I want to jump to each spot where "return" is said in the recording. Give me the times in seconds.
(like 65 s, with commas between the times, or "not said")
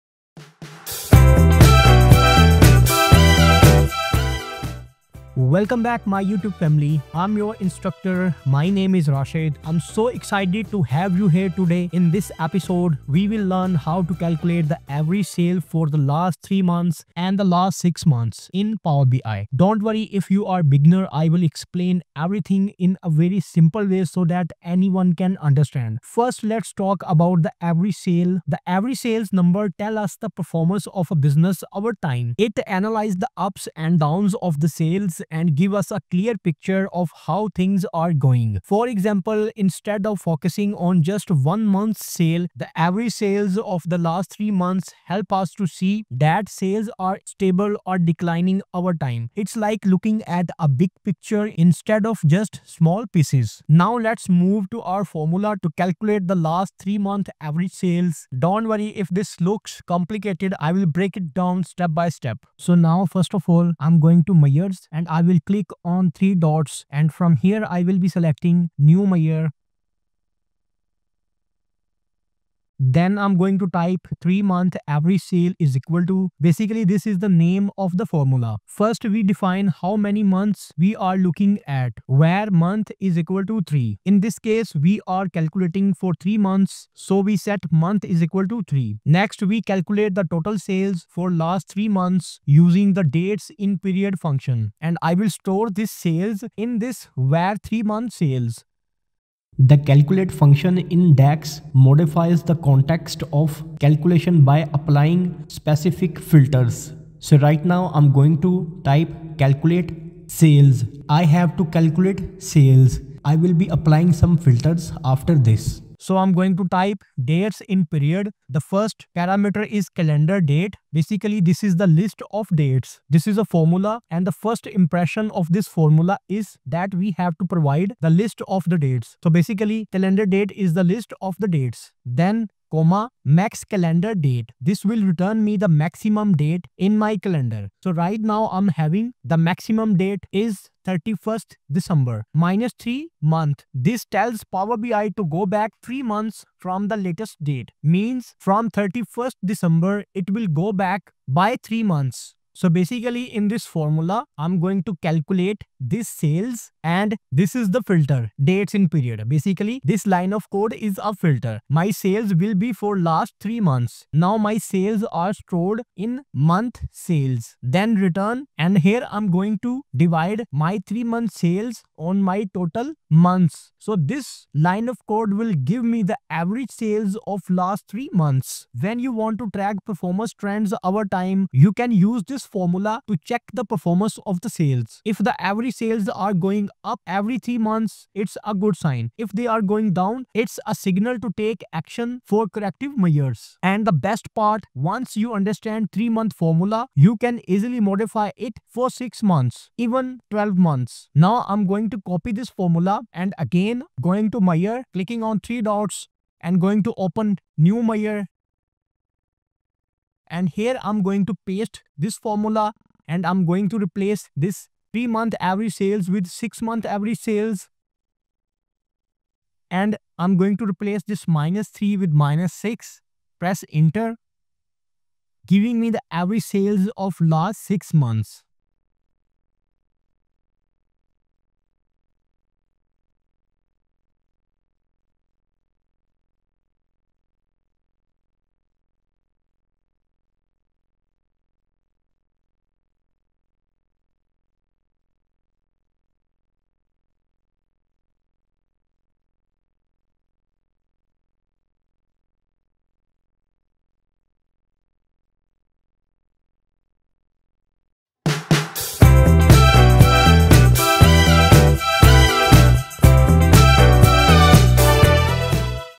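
135 s, 167 s.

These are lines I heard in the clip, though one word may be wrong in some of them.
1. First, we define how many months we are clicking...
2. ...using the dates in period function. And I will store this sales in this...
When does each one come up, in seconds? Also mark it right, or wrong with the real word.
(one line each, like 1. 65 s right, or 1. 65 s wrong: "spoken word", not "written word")
1. 78 s wrong: "looking", not "clicking"
2. 92 s right.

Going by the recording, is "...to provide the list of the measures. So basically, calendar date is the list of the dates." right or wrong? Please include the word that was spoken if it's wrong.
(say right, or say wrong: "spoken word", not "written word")
wrong: "dates", not "measures".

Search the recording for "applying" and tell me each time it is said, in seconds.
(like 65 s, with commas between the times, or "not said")
104 s, 113 s.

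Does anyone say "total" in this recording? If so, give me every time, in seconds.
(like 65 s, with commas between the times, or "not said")
90 s, 172 s.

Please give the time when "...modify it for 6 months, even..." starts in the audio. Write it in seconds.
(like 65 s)
197 s.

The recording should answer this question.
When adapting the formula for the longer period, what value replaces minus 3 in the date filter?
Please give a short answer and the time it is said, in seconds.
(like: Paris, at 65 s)
-6, at 222 s.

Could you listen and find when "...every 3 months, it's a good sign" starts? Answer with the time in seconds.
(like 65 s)
187 s.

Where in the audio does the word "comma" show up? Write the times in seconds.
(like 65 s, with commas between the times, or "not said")
132 s.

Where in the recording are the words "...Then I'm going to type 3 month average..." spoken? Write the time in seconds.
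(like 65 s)
72 s.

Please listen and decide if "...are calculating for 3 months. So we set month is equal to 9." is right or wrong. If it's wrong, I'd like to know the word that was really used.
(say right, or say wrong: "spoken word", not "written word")
wrong: "3", not "9".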